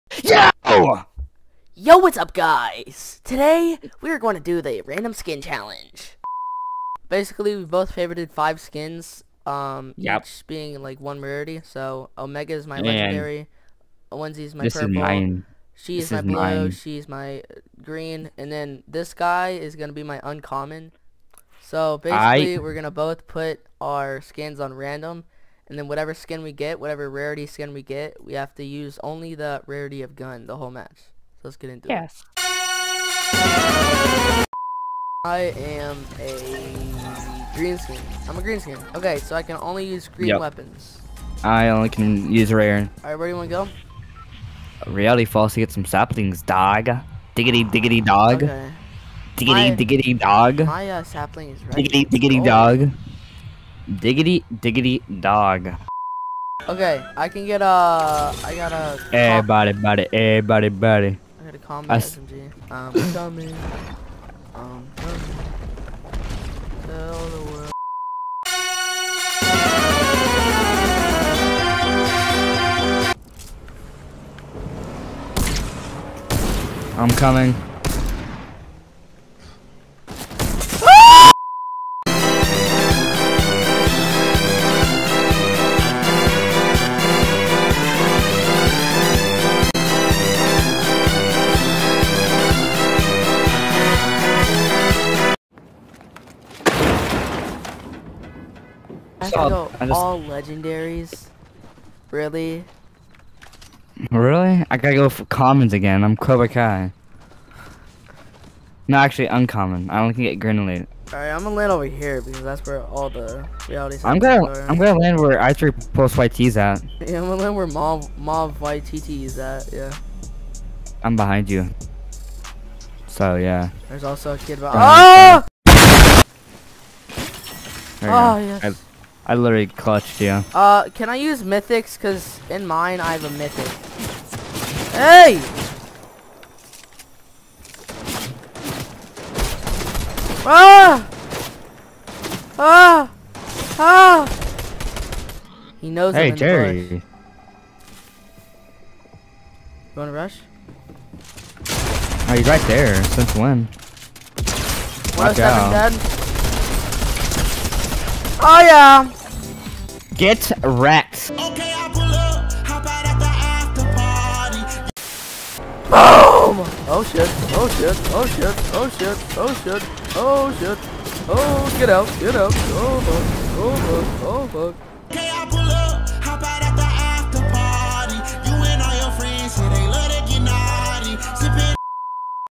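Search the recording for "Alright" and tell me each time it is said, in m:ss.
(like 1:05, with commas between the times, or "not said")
0:43, 1:51.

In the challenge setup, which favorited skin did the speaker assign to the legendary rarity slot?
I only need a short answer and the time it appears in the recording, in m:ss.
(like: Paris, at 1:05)
Omega, at 0:12.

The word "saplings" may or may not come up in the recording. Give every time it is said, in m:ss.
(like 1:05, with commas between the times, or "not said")
0:45, 0:51.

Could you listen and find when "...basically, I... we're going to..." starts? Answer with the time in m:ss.
0:21.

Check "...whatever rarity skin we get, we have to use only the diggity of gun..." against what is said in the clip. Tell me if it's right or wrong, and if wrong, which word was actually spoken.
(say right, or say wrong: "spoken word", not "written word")
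wrong: "rarity", not "diggity".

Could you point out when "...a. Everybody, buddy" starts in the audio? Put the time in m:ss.
0:58.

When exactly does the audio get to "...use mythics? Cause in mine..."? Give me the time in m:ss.
2:11.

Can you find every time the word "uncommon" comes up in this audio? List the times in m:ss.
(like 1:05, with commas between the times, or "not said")
0:20, 1:49.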